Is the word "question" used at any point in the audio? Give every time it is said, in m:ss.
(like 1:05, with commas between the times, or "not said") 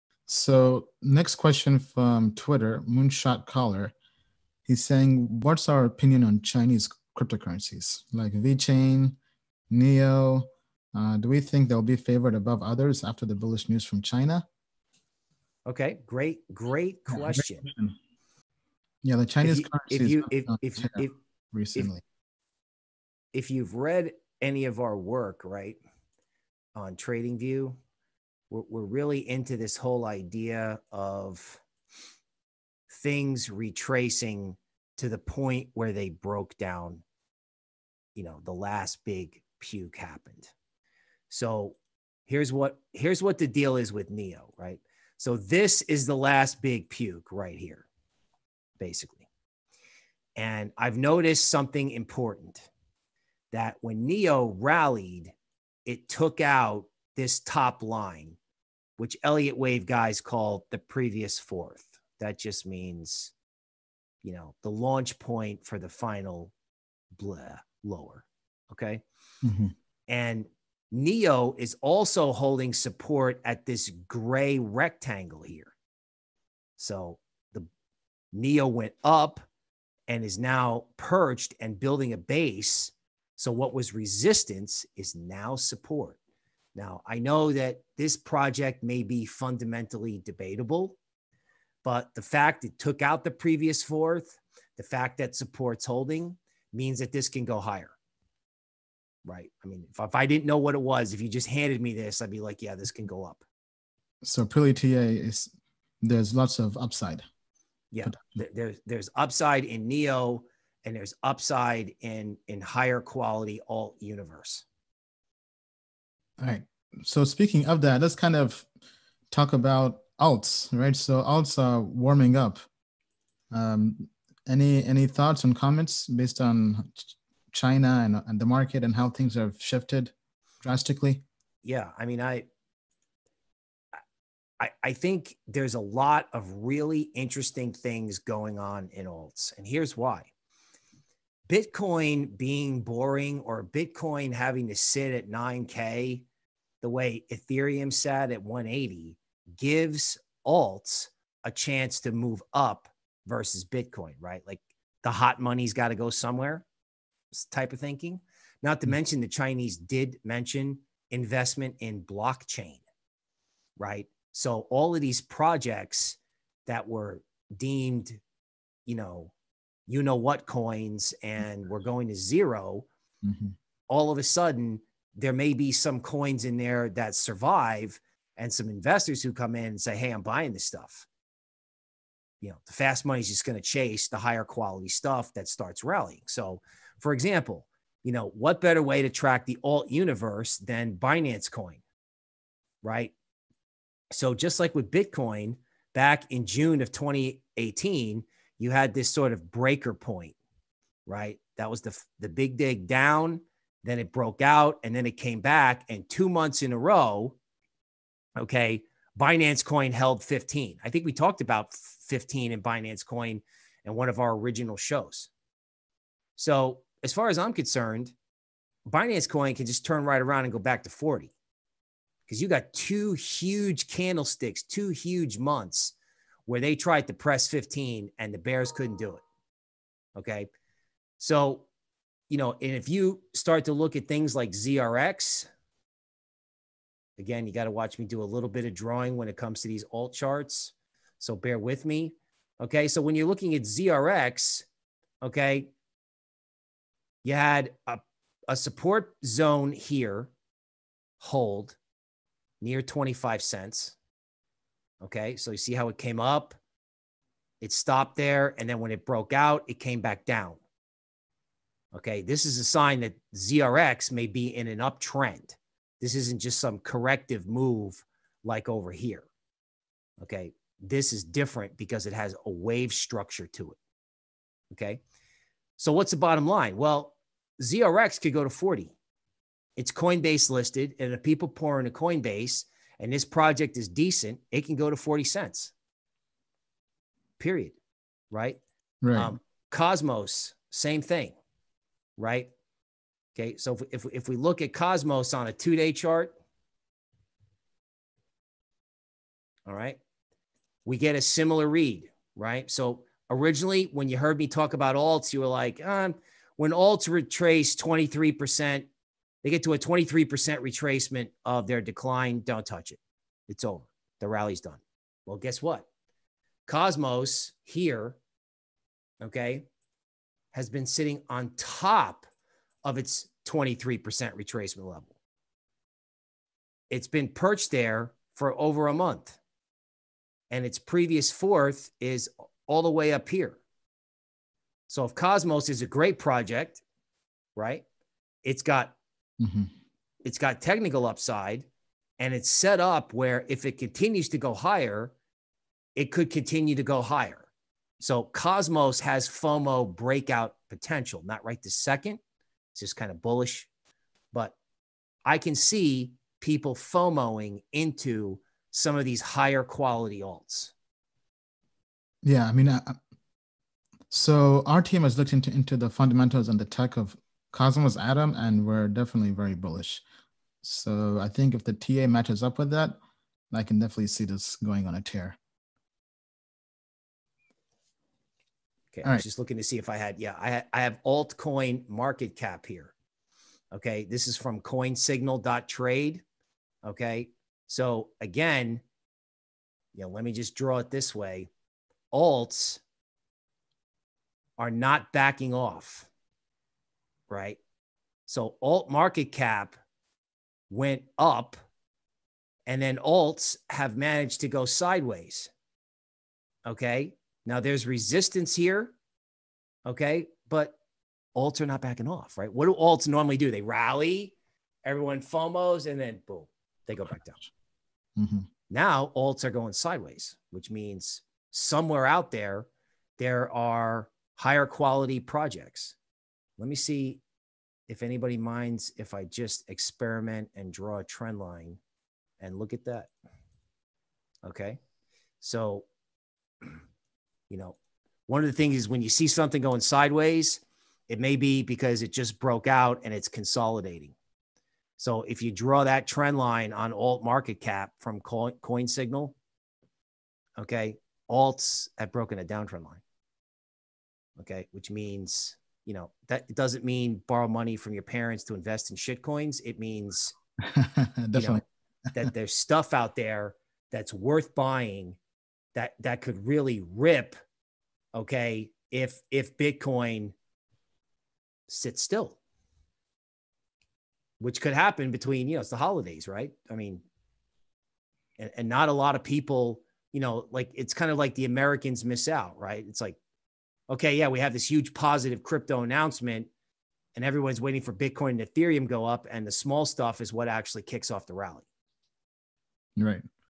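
0:01, 0:17.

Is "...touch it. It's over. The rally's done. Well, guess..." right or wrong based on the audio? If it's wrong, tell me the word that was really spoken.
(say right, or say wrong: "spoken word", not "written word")
right.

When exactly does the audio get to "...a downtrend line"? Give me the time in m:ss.
7:32.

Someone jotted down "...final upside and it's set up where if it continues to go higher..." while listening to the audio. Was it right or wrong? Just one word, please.
wrong.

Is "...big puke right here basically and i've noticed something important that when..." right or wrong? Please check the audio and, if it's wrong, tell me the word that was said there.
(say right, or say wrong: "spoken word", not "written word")
right.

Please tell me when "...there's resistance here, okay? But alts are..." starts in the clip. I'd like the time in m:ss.
6:47.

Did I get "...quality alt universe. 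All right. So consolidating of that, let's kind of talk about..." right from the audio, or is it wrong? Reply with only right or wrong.
wrong.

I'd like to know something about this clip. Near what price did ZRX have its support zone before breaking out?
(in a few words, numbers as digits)
25 cents.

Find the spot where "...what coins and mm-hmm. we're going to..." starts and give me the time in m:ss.
2:50.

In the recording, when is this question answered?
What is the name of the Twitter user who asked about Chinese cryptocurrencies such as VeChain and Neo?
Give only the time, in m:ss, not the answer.
0:02.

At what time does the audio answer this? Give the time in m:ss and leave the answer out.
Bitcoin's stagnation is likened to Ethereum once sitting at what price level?
2:28.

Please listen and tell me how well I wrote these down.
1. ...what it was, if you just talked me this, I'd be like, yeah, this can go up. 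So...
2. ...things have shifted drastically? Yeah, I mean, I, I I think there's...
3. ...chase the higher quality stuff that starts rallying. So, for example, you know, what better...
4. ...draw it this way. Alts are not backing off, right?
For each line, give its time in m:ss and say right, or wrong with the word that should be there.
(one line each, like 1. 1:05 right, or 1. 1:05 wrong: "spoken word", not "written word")
1. 1:40 wrong: "handed", not "talked"
2. 2:09 right
3. 3:03 right
4. 6:30 right.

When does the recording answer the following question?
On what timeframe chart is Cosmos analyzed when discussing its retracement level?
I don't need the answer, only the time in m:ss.
4:55.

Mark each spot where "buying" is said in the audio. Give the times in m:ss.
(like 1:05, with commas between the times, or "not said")
3:00, 7:44.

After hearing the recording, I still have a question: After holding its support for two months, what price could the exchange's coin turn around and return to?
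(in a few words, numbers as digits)
40.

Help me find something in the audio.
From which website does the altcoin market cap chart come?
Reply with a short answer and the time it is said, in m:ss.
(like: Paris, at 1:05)
coinsignal.trade, at 6:24.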